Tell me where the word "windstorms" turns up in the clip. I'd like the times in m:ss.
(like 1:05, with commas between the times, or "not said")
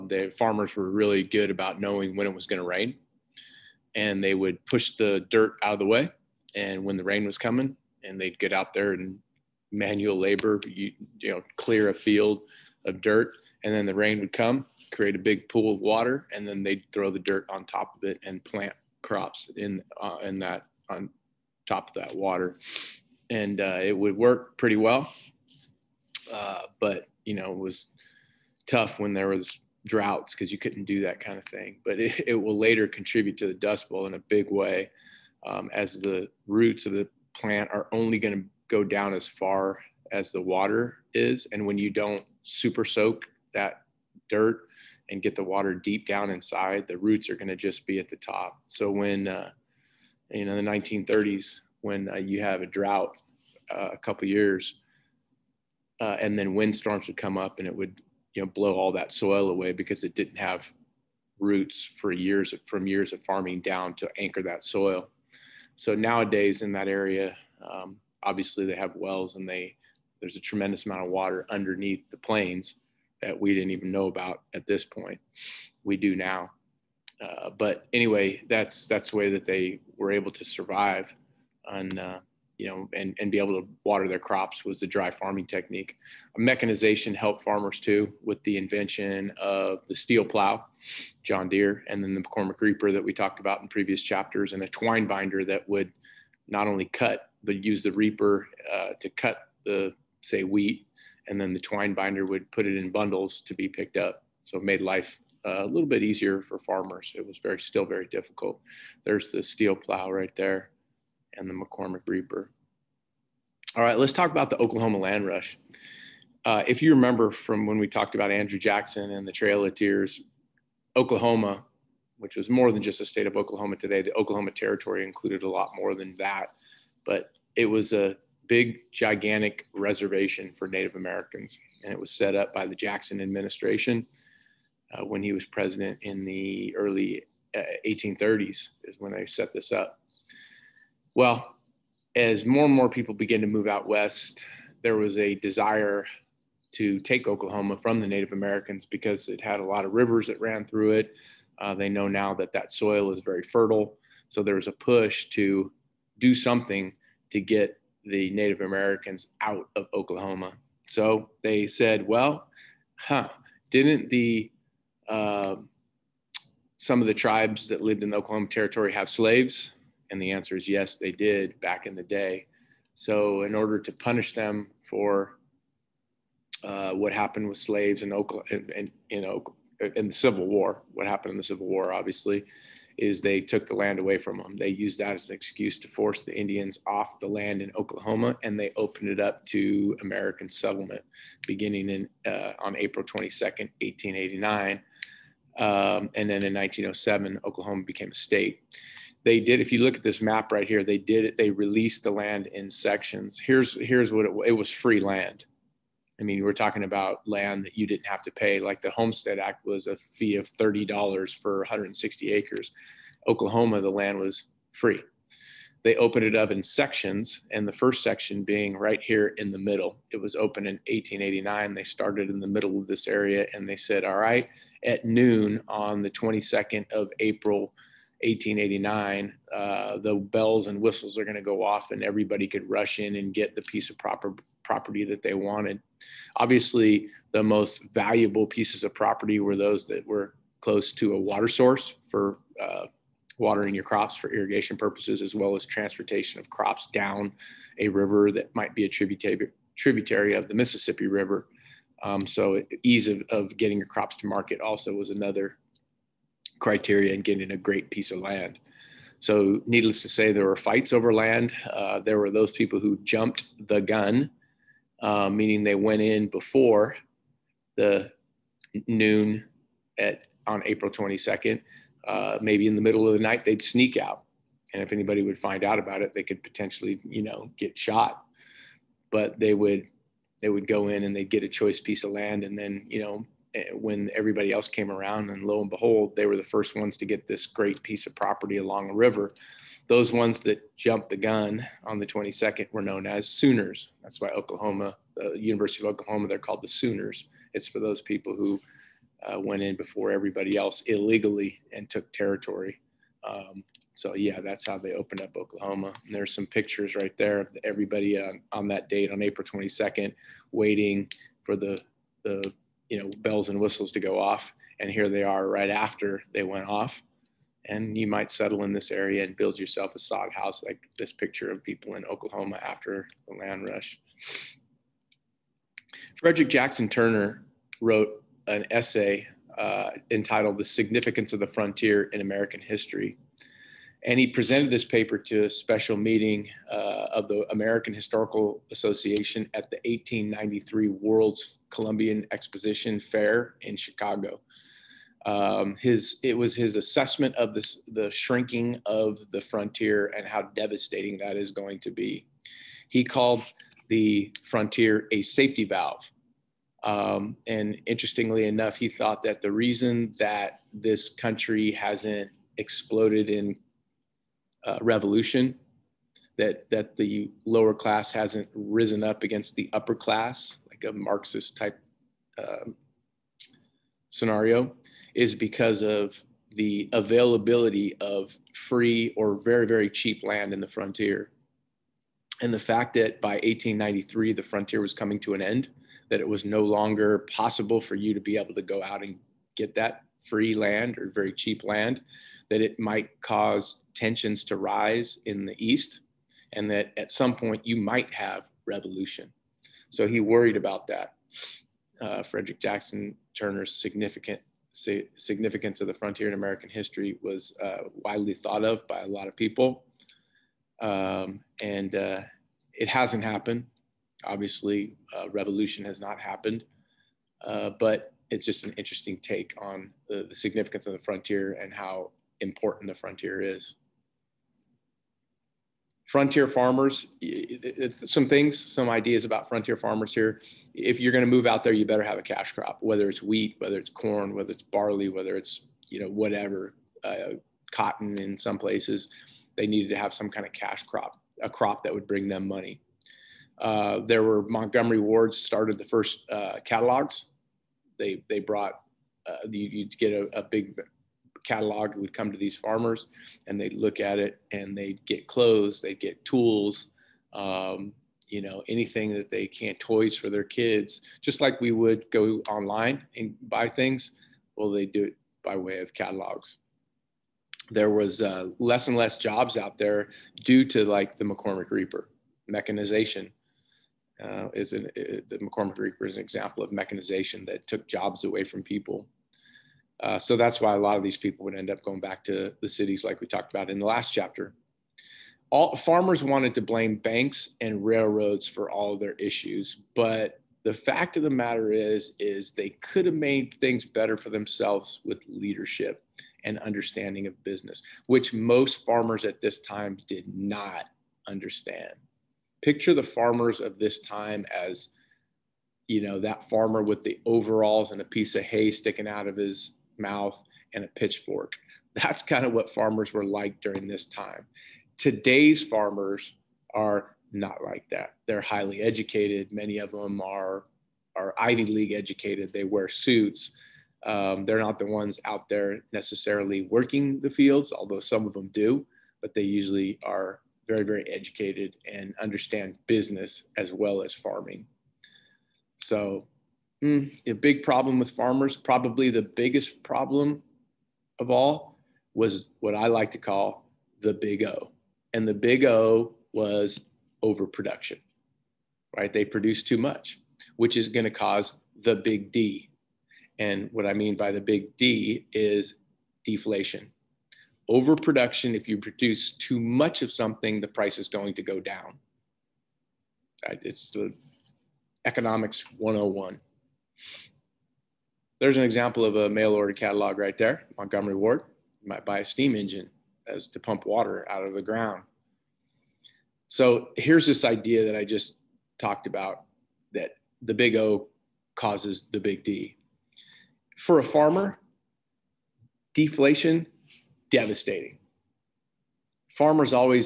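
0:56.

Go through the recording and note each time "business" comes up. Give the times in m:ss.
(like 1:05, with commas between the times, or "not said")
8:17, 8:52.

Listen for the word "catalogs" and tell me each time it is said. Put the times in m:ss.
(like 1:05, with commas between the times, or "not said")
7:26, 7:31, 7:45, 9:29.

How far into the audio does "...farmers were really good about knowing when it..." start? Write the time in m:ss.
0:00.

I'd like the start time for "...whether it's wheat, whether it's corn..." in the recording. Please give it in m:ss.
7:12.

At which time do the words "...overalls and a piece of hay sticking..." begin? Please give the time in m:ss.
8:27.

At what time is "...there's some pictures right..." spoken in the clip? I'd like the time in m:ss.
5:06.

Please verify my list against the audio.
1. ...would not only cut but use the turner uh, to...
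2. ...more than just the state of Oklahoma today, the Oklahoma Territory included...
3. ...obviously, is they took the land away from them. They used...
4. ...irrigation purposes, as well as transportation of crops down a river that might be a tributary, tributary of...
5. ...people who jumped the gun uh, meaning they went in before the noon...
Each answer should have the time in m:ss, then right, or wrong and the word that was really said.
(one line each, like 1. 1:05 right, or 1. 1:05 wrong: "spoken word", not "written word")
1. 1:35 wrong: "reaper", not "turner"
2. 2:02 right
3. 3:01 right
4. 4:04 right
5. 4:22 right.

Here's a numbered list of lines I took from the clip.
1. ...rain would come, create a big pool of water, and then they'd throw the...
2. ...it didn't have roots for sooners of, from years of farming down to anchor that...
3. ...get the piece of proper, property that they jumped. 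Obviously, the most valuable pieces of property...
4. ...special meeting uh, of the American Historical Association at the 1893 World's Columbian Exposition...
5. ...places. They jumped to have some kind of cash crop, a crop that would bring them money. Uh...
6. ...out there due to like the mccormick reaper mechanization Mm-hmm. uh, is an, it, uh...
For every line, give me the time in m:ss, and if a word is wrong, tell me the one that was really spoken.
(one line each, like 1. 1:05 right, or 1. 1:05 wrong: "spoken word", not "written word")
1. 0:13 right
2. 1:00 wrong: "years", not "sooners"
3. 3:53 wrong: "wanted", not "jumped"
4. 5:35 right
5. 7:18 wrong: "needed", not "jumped"
6. 7:49 right.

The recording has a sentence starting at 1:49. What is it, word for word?
There's the steel plow right there and the McCormick Reaper.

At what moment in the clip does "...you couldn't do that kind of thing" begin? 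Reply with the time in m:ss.
0:30.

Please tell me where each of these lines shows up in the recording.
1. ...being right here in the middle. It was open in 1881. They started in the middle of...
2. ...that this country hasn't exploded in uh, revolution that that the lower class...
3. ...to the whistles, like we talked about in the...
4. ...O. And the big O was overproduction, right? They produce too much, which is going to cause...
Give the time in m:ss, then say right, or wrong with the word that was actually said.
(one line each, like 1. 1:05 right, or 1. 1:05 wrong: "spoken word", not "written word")
1. 3:38 wrong: "1889", not "1881"
2. 6:00 right
3. 8:02 wrong: "cities", not "whistles"
4. 9:04 right.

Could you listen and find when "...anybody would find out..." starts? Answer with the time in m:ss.
4:34.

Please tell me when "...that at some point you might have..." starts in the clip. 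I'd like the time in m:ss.
6:36.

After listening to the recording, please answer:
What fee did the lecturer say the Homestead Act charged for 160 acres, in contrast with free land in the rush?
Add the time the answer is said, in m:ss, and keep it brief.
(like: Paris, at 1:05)
$30, at 3:30.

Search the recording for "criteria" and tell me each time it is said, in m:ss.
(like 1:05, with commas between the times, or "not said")
4:16.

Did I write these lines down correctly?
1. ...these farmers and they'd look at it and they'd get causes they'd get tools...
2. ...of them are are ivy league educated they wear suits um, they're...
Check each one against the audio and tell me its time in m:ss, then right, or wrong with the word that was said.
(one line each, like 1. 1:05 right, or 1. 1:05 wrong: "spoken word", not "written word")
1. 7:32 wrong: "clothes", not "causes"
2. 8:39 right.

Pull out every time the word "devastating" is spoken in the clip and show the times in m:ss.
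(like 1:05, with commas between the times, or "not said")
5:50, 9:47.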